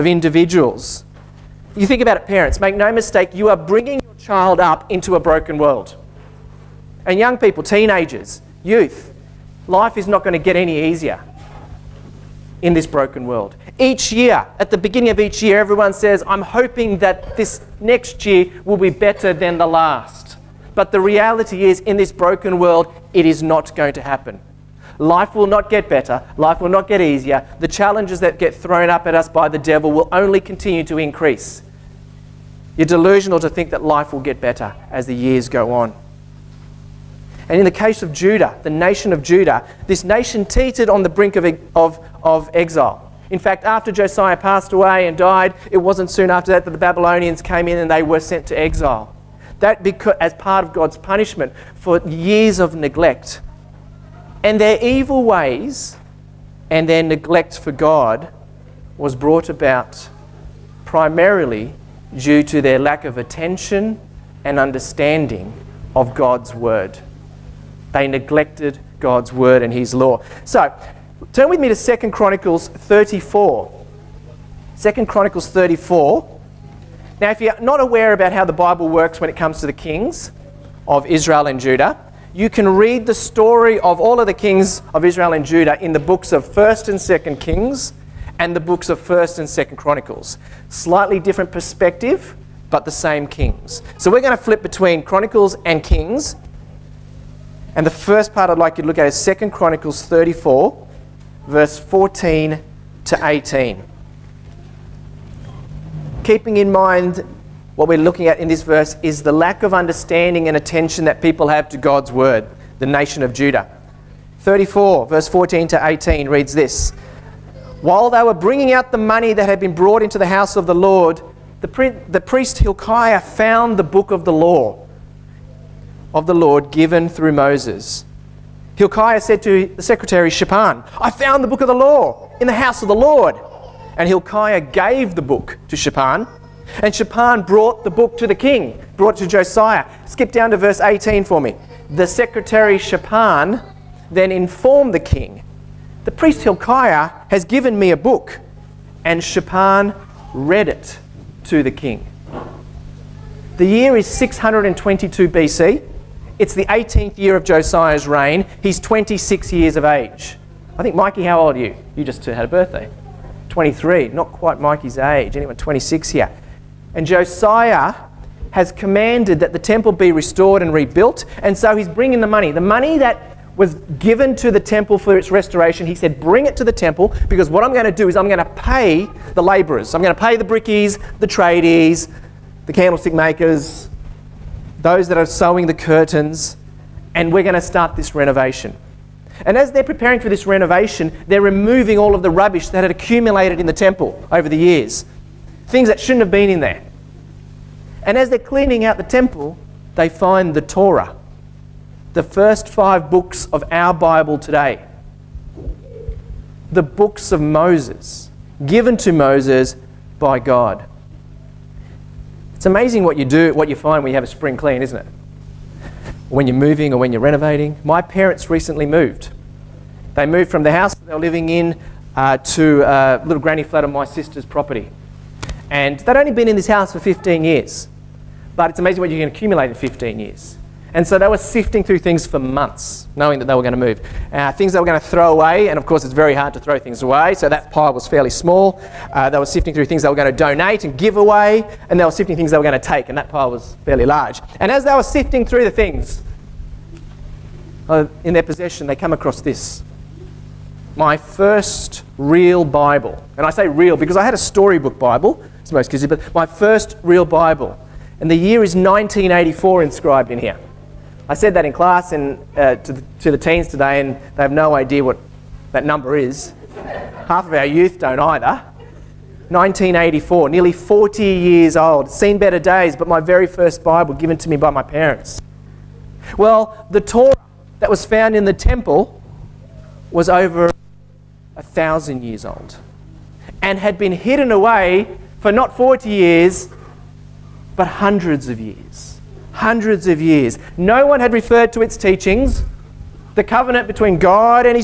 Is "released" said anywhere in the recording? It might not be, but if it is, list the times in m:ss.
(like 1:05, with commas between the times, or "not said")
not said.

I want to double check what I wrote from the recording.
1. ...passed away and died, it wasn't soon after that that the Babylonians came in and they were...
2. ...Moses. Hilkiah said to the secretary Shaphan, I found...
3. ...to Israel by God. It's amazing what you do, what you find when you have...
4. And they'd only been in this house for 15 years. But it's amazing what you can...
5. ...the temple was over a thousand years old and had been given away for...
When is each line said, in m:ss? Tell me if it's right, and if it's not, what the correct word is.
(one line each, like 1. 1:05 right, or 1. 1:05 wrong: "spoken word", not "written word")
1. 0:44 right
2. 2:07 right
3. 3:28 wrong: "Moses", not "Israel"
4. 3:45 right
5. 4:38 wrong: "hidden", not "given".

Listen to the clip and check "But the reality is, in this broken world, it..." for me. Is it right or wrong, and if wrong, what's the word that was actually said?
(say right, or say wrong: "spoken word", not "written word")
right.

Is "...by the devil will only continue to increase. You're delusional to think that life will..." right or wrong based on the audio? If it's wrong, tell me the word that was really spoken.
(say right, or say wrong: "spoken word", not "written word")
right.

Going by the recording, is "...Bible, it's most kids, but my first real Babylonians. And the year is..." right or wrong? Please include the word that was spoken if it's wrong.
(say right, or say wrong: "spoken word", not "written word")
wrong: "Bible", not "Babylonians".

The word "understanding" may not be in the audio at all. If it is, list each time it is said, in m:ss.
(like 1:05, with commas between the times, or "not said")
1:04, 1:49.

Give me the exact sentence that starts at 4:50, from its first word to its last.
No one had referred to its teachings.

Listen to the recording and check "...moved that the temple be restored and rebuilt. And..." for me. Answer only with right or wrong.
wrong.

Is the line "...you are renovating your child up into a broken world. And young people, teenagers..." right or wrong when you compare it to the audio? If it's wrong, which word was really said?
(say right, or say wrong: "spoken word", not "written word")
wrong: "bringing", not "renovating".